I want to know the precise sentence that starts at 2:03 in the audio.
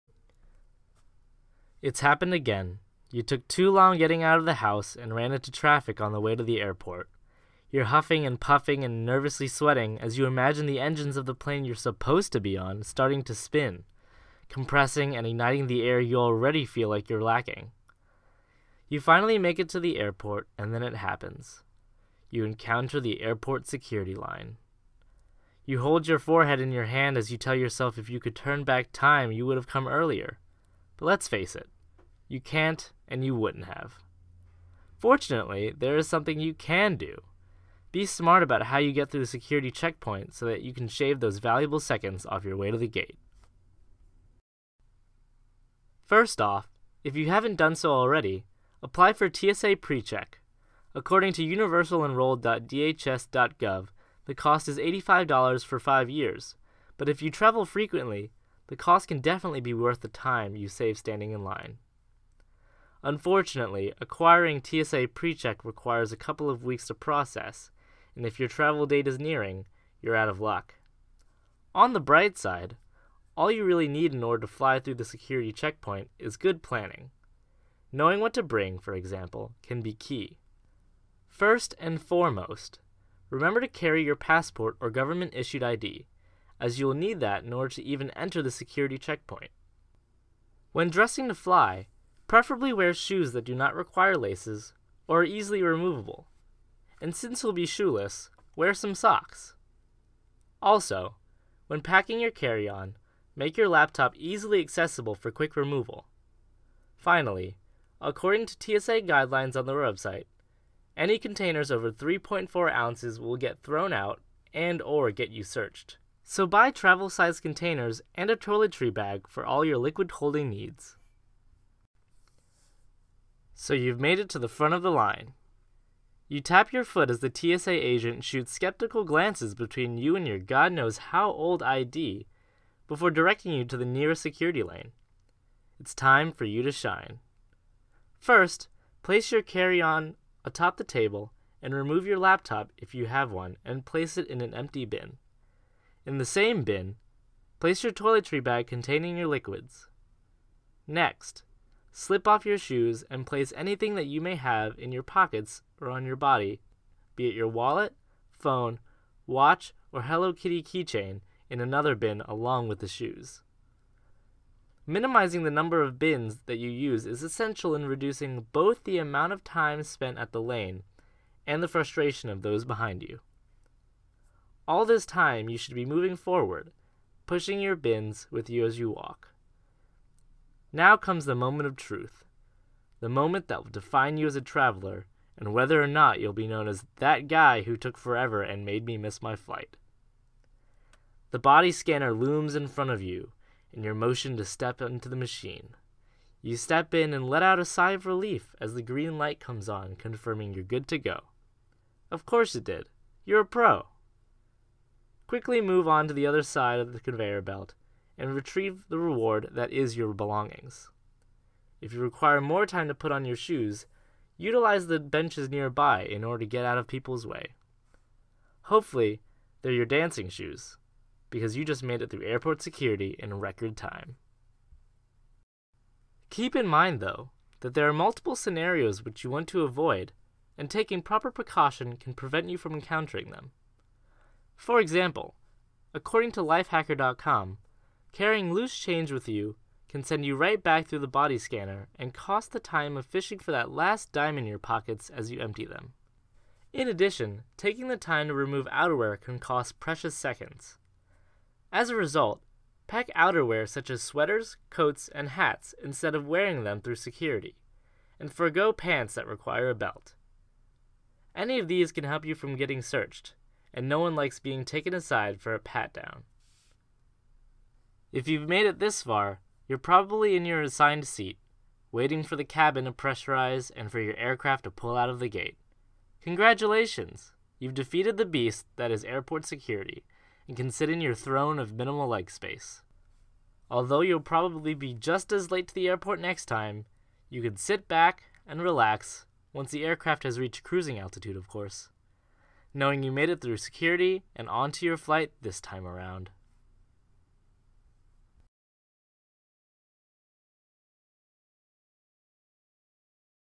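So you've made it to the front of the line.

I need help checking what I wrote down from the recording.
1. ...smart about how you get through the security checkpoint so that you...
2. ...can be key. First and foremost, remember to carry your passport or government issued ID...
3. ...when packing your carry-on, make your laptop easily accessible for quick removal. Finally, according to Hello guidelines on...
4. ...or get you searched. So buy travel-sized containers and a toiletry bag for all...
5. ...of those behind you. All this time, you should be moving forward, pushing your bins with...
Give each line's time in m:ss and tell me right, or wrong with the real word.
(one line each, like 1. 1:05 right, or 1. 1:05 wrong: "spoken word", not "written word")
1. 0:38 right
2. 1:19 right
3. 1:41 wrong: "TSA", not "Hello"
4. 1:54 right
5. 2:52 right.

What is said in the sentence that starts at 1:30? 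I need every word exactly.
When dressing to fly, preferably wear shoes that do not require laces or are easily removable.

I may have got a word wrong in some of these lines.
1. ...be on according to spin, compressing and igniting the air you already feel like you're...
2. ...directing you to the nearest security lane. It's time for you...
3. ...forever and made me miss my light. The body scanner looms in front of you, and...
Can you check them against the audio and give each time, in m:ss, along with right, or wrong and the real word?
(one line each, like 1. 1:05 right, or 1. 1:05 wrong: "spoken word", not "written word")
1. 0:12 wrong: "starting", not "according"
2. 2:13 right
3. 3:07 wrong: "flight", not "light".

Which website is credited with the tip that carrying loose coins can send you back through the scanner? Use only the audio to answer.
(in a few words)
lifehacker.com.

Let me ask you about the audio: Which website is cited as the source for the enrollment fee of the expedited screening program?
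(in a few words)
universalenrolled.dhs.gov.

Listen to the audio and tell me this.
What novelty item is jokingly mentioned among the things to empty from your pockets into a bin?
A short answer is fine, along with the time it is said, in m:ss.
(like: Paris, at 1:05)
Hello Kitty keychain, at 2:40.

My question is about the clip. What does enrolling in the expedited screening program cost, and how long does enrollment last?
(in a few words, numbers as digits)
$85 for 5 years.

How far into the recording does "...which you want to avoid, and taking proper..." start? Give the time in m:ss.
3:49.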